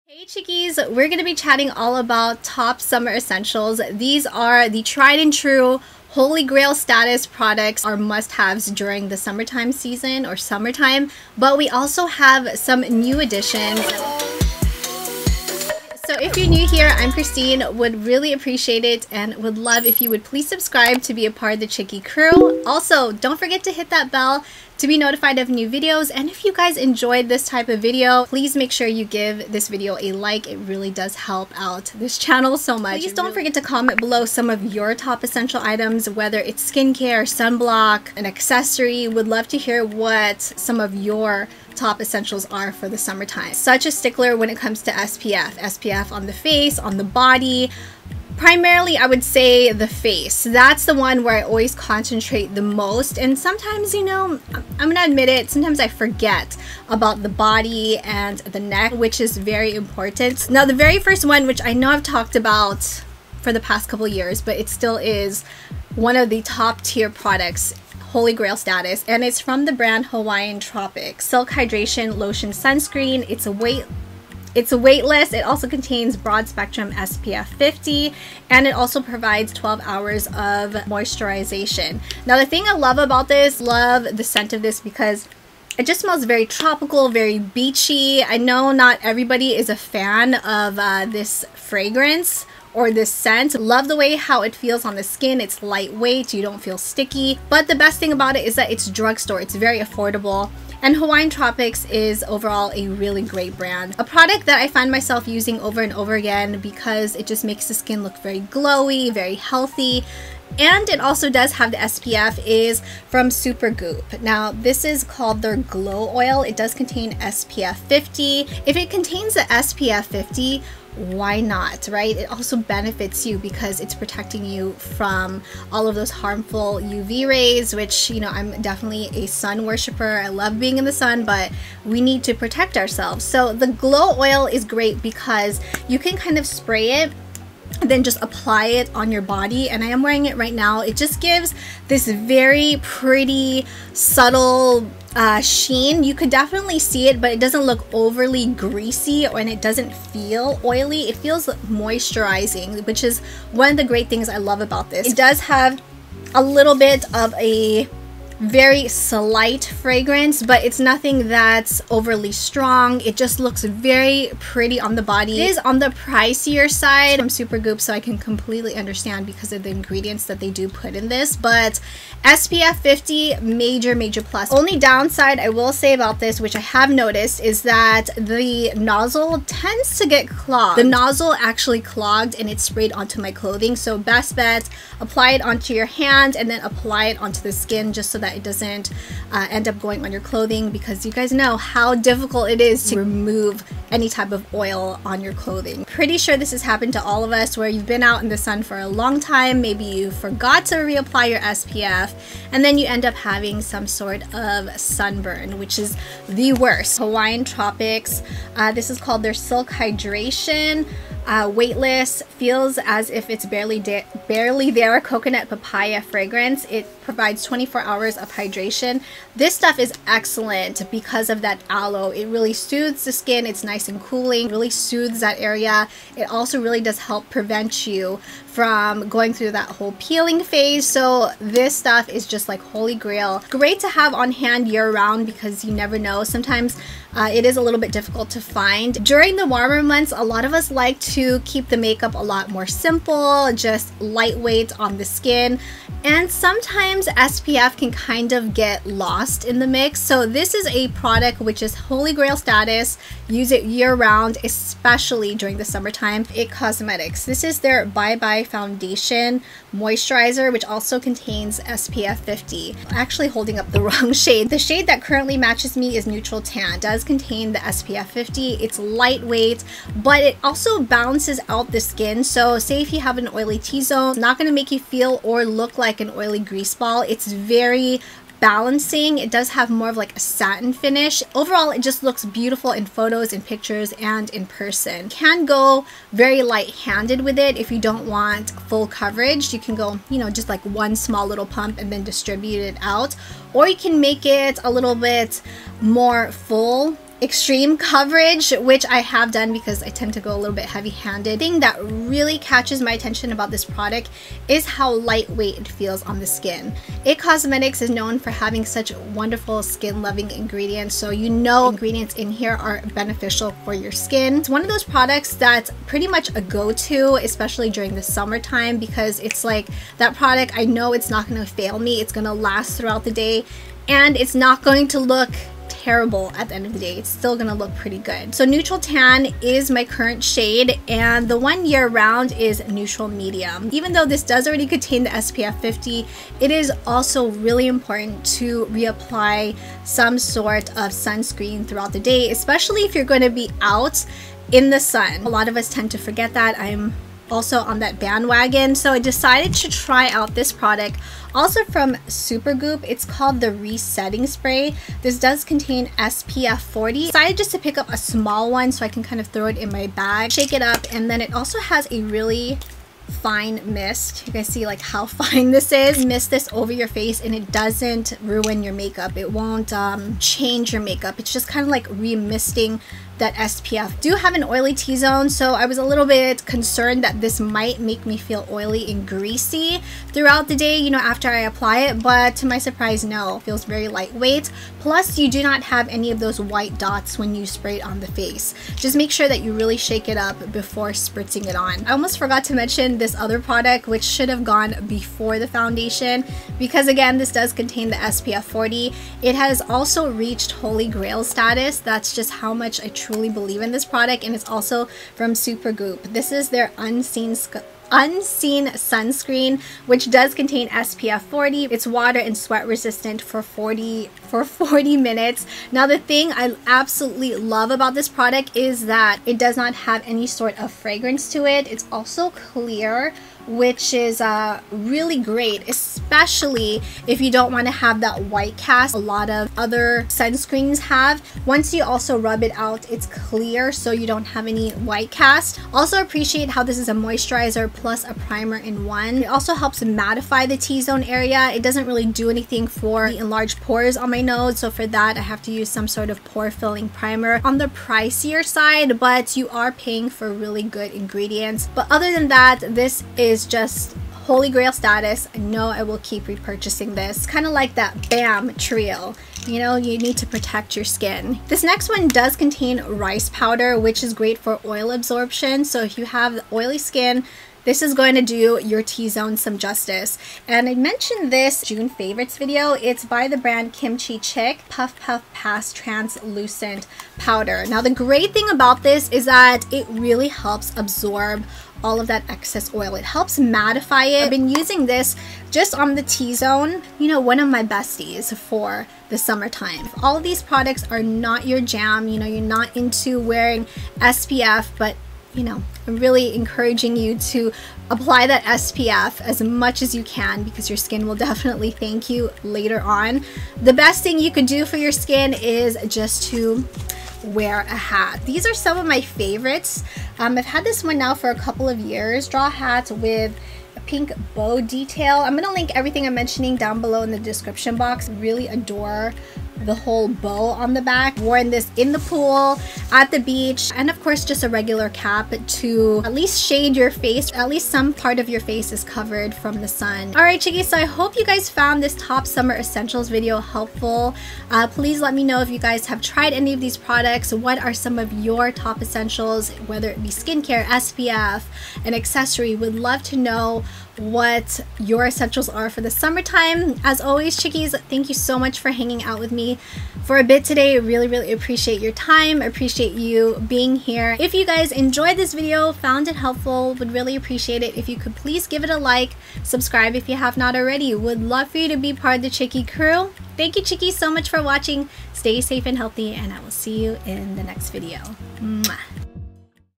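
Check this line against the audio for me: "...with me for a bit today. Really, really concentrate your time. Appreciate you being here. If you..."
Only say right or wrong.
wrong.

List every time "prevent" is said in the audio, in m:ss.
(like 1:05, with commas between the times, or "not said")
3:47.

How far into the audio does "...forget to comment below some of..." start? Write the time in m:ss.
0:33.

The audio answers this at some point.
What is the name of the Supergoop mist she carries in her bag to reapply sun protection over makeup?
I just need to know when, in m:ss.
5:53.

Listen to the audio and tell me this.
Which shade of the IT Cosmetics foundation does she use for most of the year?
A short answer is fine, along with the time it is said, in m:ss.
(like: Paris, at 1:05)
Neutral Medium, at 5:32.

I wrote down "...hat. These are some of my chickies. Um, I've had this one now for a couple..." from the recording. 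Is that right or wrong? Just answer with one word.
wrong.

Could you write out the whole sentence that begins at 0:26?
And if you guys enjoyed this type of video, please make sure you give this video a like.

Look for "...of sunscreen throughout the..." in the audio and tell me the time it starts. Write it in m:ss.
5:40.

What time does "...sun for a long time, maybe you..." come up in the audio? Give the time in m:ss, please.
3:18.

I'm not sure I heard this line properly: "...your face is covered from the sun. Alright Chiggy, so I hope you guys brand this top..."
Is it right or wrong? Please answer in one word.
wrong.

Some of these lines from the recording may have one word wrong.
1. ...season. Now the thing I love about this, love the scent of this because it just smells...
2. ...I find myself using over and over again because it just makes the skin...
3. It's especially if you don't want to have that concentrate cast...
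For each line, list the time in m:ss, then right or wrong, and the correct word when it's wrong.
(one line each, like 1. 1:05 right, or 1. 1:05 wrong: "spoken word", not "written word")
1. 1:20 wrong: "moisturization", not "season"
2. 1:44 right
3. 7:05 wrong: "white", not "concentrate".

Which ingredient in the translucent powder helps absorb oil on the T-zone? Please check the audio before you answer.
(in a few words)
rice powder.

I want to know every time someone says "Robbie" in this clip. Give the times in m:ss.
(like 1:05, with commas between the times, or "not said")
not said.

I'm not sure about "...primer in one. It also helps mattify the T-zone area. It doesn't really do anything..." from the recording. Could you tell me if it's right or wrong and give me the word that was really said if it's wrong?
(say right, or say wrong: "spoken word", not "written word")
right.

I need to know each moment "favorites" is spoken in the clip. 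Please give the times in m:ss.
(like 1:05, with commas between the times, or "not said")
7:51, 8:29.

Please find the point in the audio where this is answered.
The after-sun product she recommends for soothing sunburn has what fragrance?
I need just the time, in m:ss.
3:34.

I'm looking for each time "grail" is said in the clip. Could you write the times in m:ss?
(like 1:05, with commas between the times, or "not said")
0:06, 1:08, 3:52, 4:12, 6:40, 7:34.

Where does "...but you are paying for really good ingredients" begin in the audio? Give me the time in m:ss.
7:28.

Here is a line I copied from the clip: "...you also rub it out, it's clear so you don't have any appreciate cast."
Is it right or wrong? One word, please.
wrong.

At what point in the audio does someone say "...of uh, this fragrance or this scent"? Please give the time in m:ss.
1:30.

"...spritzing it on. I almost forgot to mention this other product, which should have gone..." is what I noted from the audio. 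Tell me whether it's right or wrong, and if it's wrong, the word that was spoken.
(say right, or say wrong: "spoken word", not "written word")
right.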